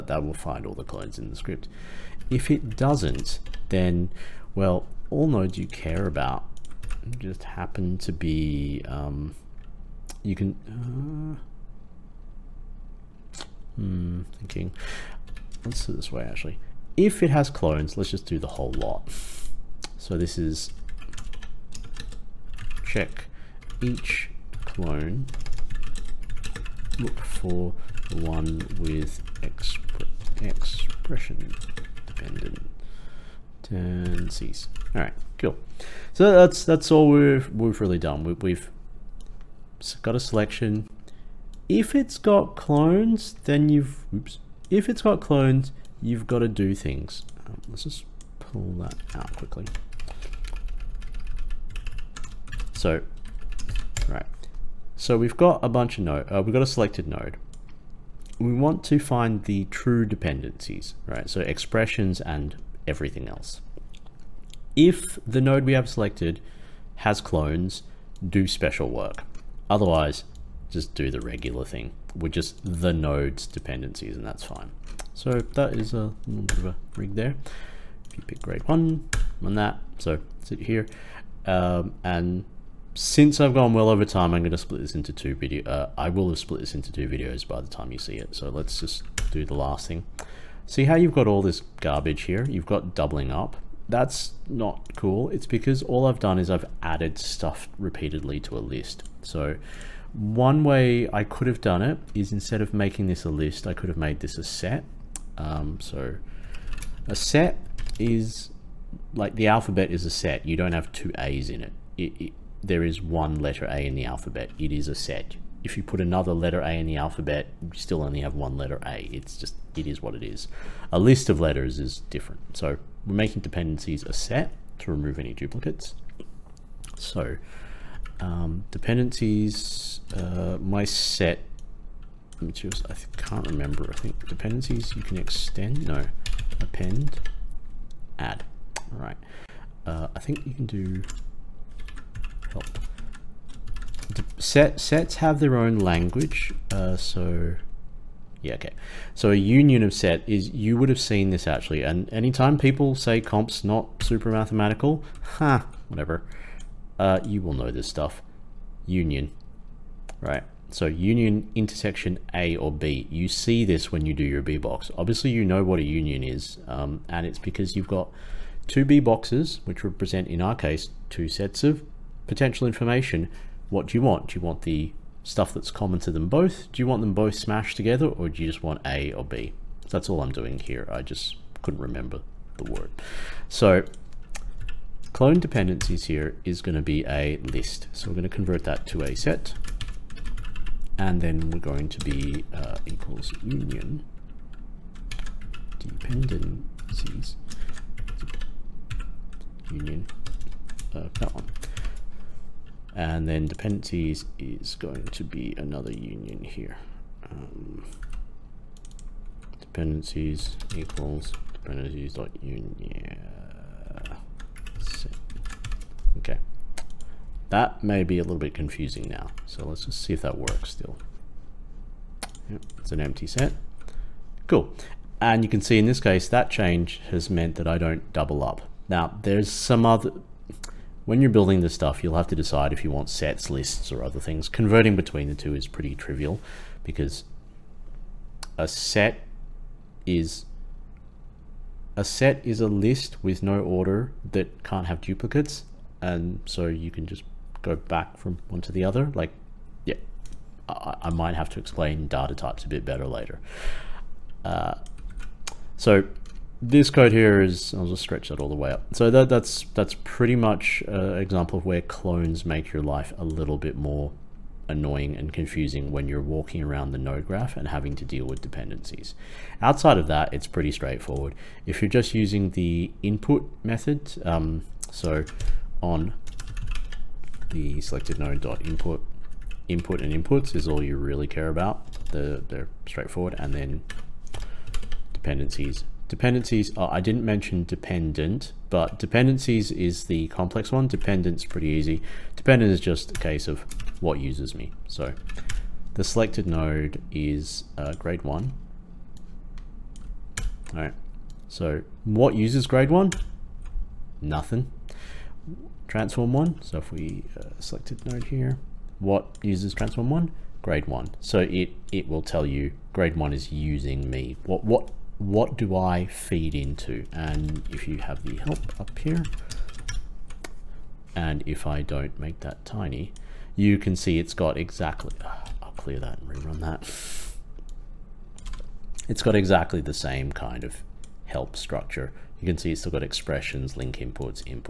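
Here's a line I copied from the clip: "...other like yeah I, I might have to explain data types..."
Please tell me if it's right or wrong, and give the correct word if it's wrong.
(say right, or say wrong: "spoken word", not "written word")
right.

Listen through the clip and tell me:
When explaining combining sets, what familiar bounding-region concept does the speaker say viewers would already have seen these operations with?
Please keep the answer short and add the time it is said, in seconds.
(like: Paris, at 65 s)
B box, at 164 s.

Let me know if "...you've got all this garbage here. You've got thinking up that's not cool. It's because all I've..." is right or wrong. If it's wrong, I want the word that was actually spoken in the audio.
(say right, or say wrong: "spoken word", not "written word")
wrong: "doubling", not "thinking".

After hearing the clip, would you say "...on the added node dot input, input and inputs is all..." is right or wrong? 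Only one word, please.
wrong.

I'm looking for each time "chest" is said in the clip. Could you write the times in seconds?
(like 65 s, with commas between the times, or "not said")
not said.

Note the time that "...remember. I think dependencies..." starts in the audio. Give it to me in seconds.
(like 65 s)
133 s.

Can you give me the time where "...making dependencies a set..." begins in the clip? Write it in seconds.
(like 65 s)
123 s.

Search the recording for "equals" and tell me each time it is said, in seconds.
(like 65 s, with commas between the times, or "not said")
192 s, 210 s.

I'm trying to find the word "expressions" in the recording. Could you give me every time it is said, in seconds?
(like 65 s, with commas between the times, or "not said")
30 s, 61 s, 333 s.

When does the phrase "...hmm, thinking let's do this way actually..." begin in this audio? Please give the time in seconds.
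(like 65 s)
13 s.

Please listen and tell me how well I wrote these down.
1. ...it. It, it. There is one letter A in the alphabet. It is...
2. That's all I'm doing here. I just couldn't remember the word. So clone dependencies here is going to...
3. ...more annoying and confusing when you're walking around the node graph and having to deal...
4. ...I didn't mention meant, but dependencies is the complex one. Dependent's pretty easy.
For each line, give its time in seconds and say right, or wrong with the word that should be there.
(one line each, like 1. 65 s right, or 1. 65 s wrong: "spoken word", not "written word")
1. 111 s right
2. 179 s right
3. 263 s right
4. 286 s wrong: "dependent", not "meant".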